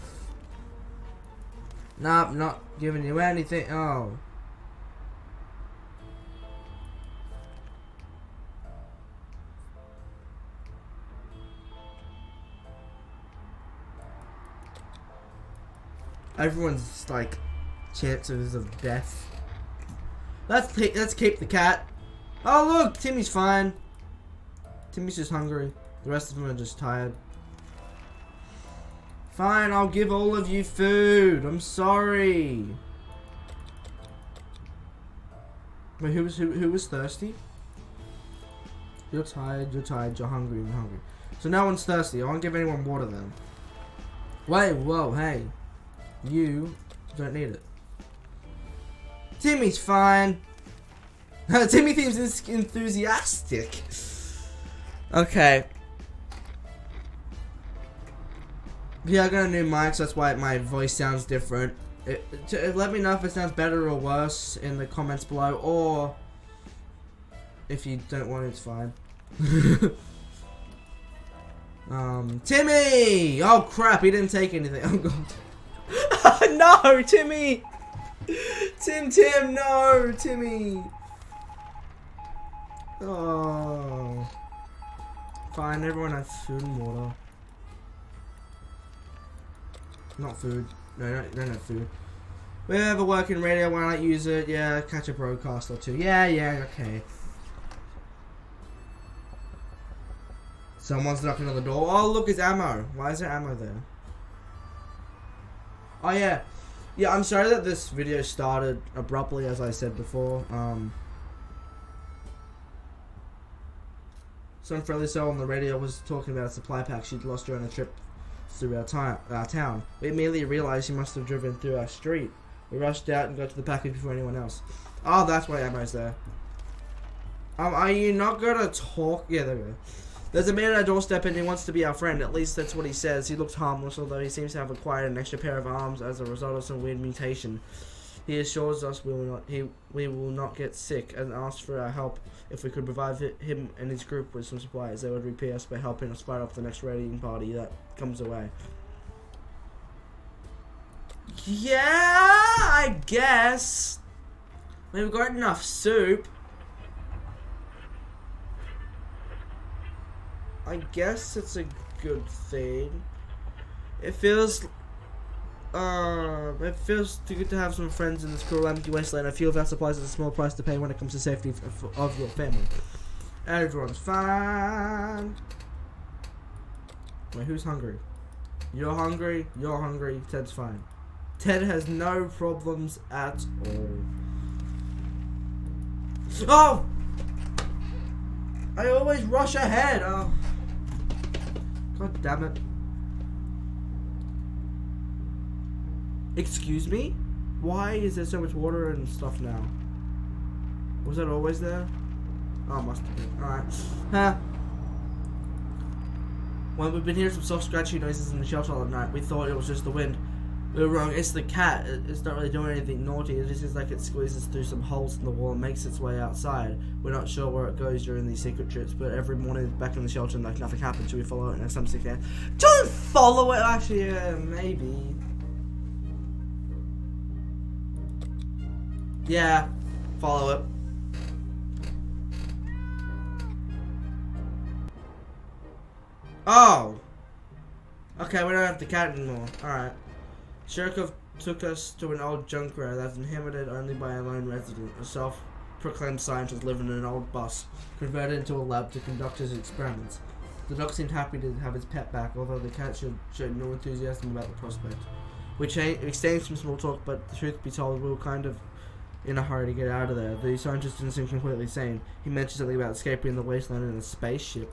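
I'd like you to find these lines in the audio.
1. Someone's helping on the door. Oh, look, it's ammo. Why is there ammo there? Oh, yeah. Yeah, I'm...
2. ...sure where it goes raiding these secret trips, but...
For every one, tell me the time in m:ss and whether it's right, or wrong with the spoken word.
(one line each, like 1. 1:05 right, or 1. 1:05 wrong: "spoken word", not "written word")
1. 1:40 wrong: "knocking", not "helping"
2. 3:37 wrong: "during", not "raiding".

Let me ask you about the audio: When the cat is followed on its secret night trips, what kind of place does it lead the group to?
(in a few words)
an old junkyard.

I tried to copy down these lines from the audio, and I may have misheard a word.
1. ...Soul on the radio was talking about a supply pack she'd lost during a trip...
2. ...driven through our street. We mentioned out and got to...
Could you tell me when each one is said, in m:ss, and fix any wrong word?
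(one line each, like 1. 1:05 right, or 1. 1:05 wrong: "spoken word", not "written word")
1. 1:55 right
2. 2:01 wrong: "rushed", not "mentioned".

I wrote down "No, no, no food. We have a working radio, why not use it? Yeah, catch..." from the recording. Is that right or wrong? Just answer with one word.
right.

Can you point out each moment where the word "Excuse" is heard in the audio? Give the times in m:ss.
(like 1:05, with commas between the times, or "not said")
3:16.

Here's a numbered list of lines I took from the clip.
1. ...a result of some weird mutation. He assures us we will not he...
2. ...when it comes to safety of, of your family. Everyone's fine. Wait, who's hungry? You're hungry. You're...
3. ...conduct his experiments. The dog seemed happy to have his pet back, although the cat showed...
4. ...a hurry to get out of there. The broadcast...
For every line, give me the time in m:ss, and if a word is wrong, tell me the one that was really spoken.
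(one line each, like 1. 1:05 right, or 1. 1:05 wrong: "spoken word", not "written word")
1. 2:16 right
2. 2:50 right
3. 4:09 right
4. 4:19 wrong: "scientist", not "broadcast".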